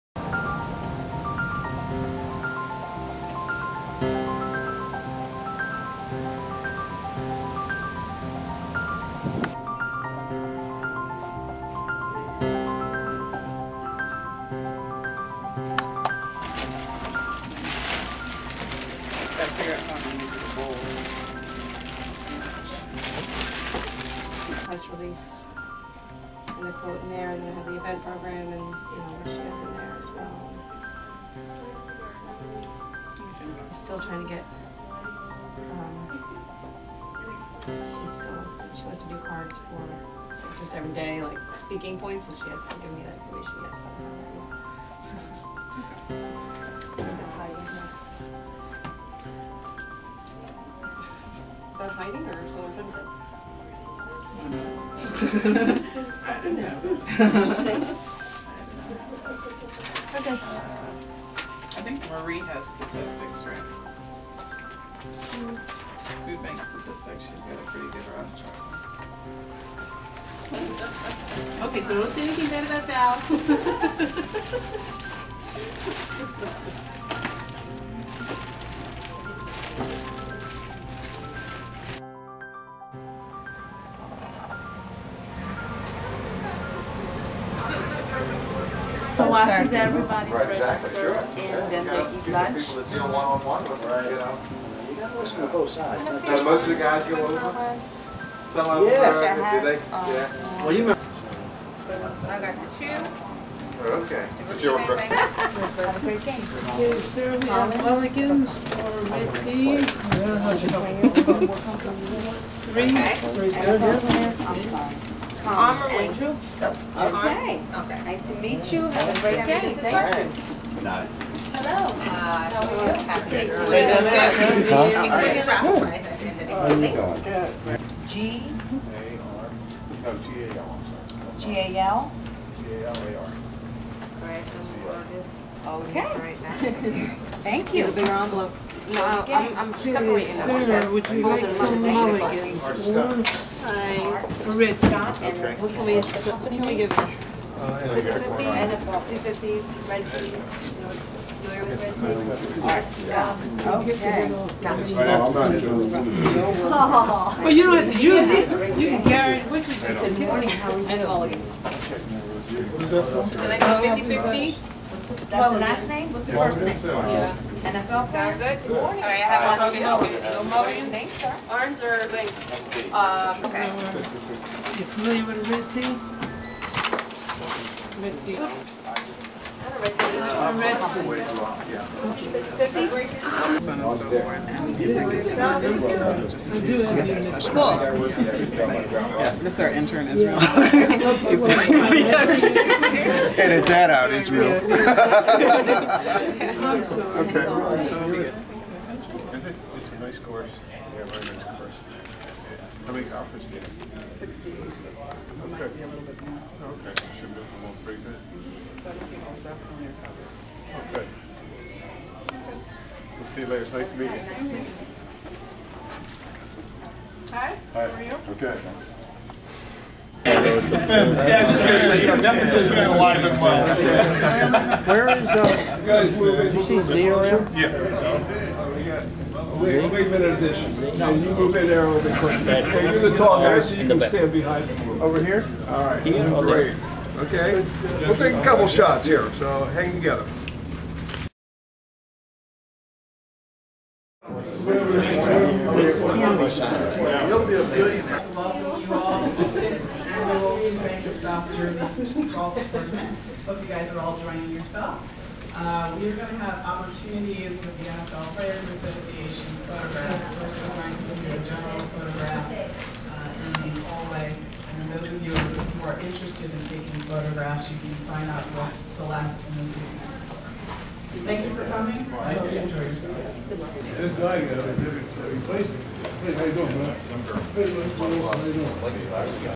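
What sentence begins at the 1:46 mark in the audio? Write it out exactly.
Is there Republicans or red tees?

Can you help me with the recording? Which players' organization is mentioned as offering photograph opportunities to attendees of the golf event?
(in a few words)
NFL Players Association.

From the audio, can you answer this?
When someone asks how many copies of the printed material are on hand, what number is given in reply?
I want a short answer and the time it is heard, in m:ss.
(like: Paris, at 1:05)
68, at 3:24.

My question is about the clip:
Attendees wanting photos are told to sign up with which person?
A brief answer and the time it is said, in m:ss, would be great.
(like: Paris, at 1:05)
Celeste, at 4:28.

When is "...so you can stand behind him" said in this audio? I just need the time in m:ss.
3:53.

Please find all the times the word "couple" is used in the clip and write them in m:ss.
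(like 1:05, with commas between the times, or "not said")
3:58.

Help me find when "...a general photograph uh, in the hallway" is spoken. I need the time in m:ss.
4:21.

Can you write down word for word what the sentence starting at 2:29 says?
Fifties, red keys, familiar with red?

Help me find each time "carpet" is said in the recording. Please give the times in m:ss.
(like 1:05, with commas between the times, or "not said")
not said.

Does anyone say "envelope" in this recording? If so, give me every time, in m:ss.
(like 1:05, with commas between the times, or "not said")
2:18.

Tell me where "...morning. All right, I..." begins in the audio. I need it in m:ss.
2:48.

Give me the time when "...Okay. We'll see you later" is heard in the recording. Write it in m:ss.
3:30.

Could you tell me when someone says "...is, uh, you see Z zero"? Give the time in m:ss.
3:45.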